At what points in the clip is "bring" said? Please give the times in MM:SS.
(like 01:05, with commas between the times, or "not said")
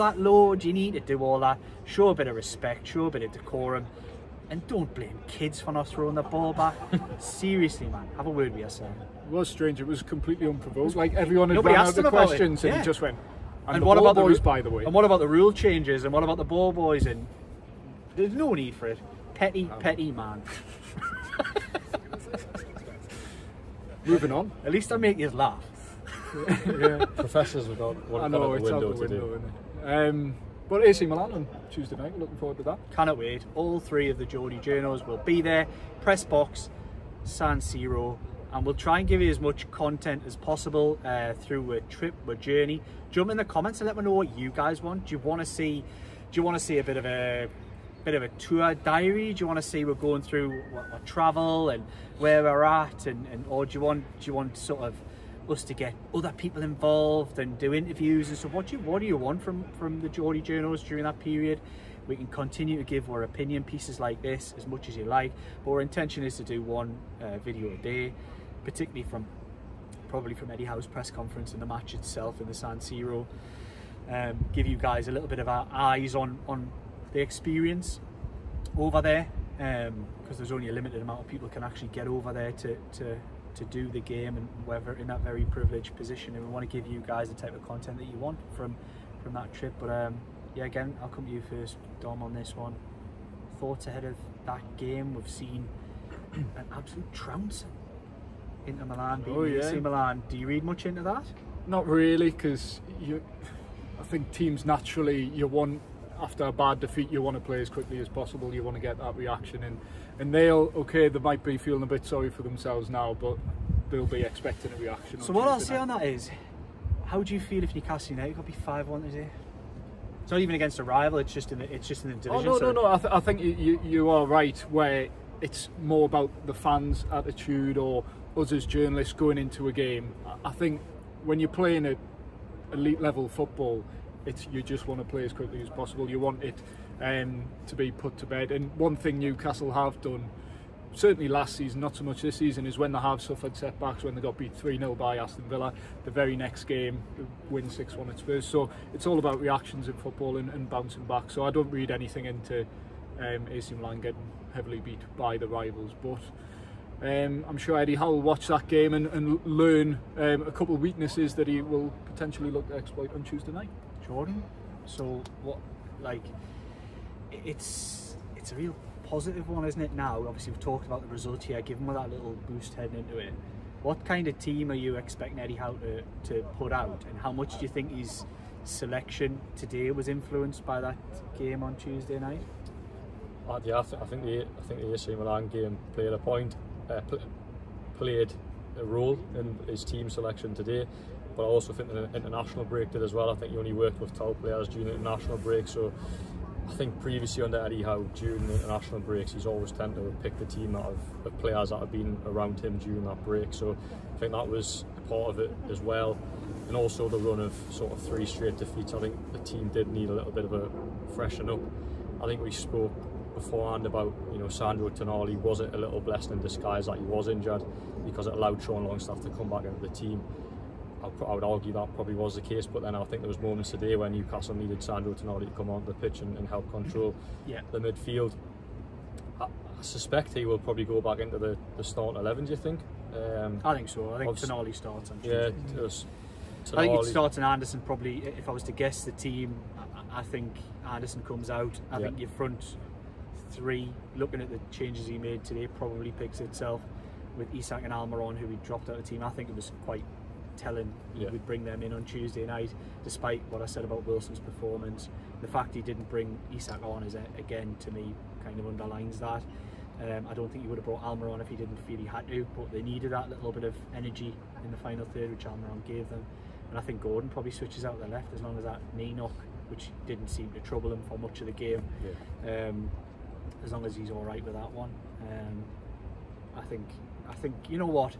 04:11, 04:16.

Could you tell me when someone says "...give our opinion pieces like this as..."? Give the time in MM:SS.
01:02.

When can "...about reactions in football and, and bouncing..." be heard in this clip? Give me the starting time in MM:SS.
02:29.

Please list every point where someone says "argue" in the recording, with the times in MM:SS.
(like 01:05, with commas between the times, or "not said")
03:41.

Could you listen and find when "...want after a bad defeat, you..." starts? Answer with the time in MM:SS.
01:45.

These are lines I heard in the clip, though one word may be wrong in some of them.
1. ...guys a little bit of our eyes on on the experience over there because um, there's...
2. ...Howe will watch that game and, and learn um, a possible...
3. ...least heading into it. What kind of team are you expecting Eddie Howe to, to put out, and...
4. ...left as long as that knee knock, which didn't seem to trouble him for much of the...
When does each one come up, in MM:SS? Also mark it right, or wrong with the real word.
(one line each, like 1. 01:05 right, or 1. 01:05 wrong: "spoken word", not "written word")
1. 01:14 right
2. 02:37 wrong: "couple", not "possible"
3. 02:52 wrong: "boost", not "least"
4. 04:28 right.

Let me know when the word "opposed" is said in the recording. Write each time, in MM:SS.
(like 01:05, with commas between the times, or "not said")
not said.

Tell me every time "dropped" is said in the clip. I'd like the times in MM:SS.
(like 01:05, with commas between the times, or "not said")
04:08.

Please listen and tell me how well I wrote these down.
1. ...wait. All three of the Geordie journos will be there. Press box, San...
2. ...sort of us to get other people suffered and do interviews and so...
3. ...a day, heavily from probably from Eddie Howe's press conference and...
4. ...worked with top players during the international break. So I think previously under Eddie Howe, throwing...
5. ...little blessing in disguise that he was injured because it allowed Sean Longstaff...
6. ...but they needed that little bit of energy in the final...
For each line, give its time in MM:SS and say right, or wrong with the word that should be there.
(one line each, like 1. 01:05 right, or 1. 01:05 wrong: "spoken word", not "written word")
1. 00:33 right
2. 00:54 wrong: "involved", not "suffered"
3. 01:07 wrong: "particularly", not "heavily"
4. 03:13 wrong: "during", not "throwing"
5. 03:35 right
6. 04:22 right.